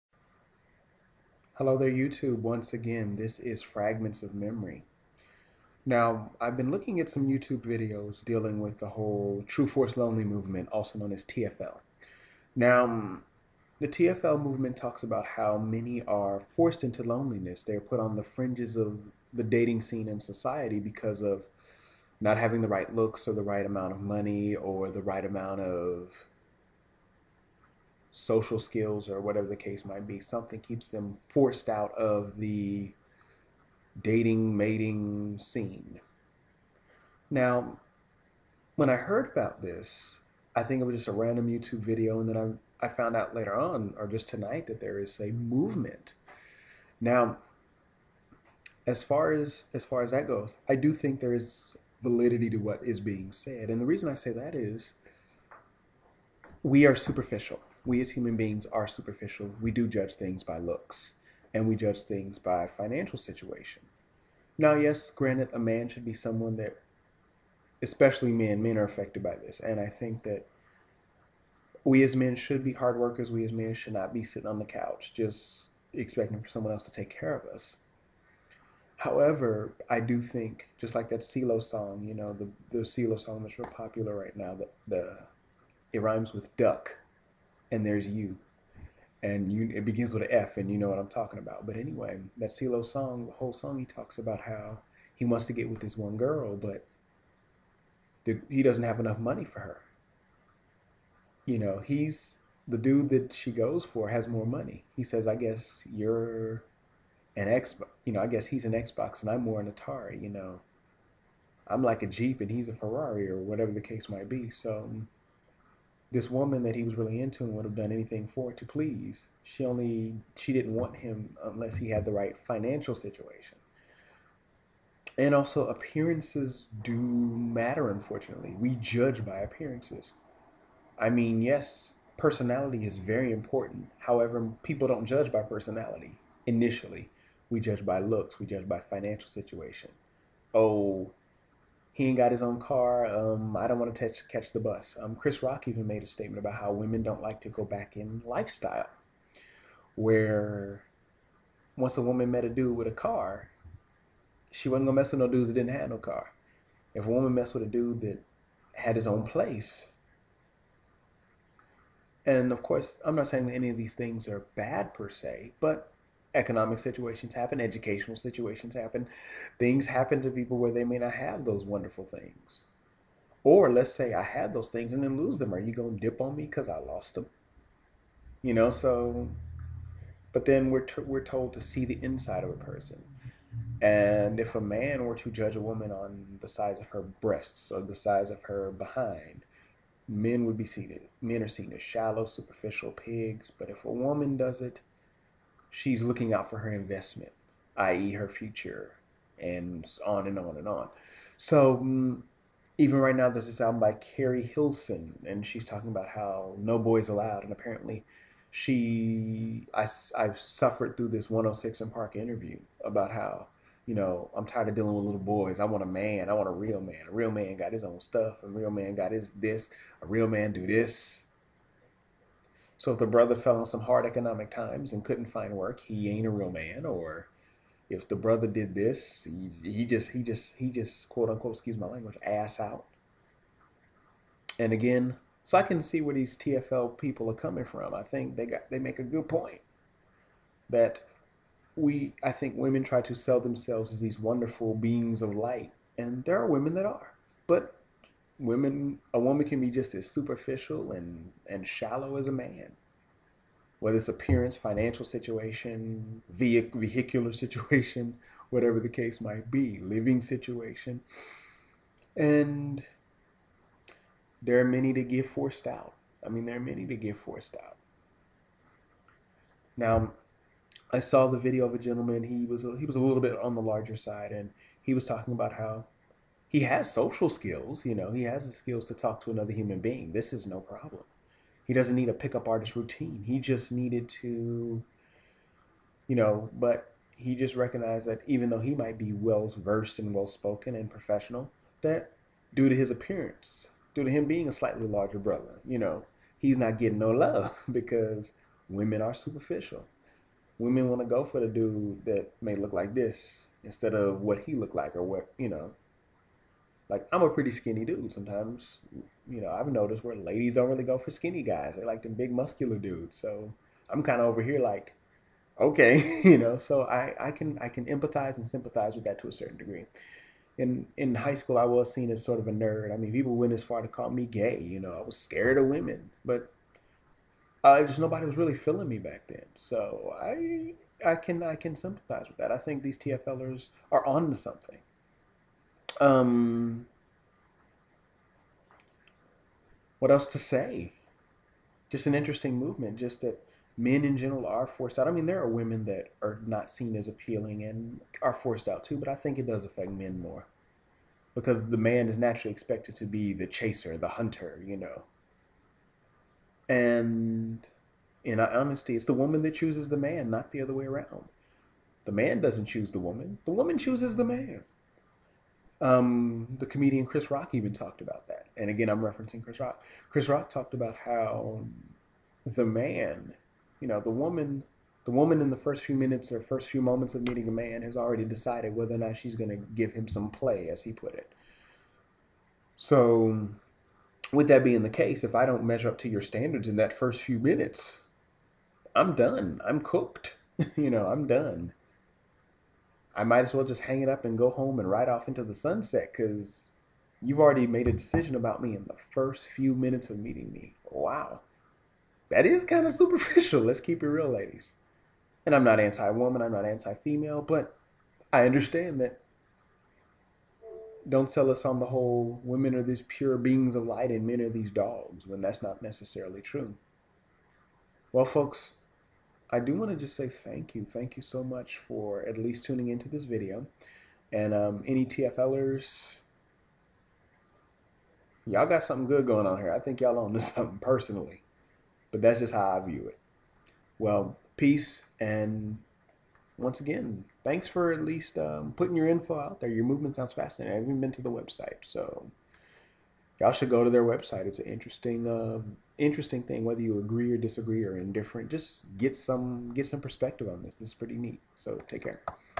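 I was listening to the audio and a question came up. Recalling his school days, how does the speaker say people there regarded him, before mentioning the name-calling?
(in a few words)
a nerd.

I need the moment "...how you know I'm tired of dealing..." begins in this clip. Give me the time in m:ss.
3:33.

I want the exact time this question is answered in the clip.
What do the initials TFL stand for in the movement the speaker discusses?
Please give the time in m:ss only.
0:09.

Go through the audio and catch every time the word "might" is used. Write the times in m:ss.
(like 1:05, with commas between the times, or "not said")
0:29, 1:54, 4:19, 4:48, 6:33.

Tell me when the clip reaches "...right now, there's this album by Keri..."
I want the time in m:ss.
3:22.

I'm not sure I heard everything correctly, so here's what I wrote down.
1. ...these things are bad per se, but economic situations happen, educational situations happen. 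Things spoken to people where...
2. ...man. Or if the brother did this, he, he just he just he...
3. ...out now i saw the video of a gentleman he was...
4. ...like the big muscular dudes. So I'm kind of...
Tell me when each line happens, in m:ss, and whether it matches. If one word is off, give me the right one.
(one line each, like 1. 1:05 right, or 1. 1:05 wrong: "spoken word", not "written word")
1. 2:43 wrong: "happen", not "spoken"
2. 3:46 right
3. 4:27 right
4. 5:11 right.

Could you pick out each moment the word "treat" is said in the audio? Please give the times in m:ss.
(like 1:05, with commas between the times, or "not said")
not said.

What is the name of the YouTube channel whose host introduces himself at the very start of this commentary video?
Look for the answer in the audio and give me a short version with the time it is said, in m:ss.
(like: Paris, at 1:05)
Fragments of Memory, at 0:03.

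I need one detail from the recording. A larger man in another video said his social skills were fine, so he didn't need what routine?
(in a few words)
pickup artist.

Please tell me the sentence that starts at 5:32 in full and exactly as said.
I think these TFLers are on to something.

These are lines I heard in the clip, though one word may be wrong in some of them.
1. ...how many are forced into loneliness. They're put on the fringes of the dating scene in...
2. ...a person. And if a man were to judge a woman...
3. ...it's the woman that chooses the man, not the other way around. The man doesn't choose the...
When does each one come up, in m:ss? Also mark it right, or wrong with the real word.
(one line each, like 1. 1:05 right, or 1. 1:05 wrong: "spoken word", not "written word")
1. 0:15 right
2. 3:02 right
3. 5:58 right.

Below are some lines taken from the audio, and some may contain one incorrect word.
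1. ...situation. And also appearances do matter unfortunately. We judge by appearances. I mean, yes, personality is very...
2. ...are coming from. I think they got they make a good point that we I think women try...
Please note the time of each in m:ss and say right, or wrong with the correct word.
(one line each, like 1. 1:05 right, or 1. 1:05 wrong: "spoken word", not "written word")
1. 2:02 right
2. 3:57 right.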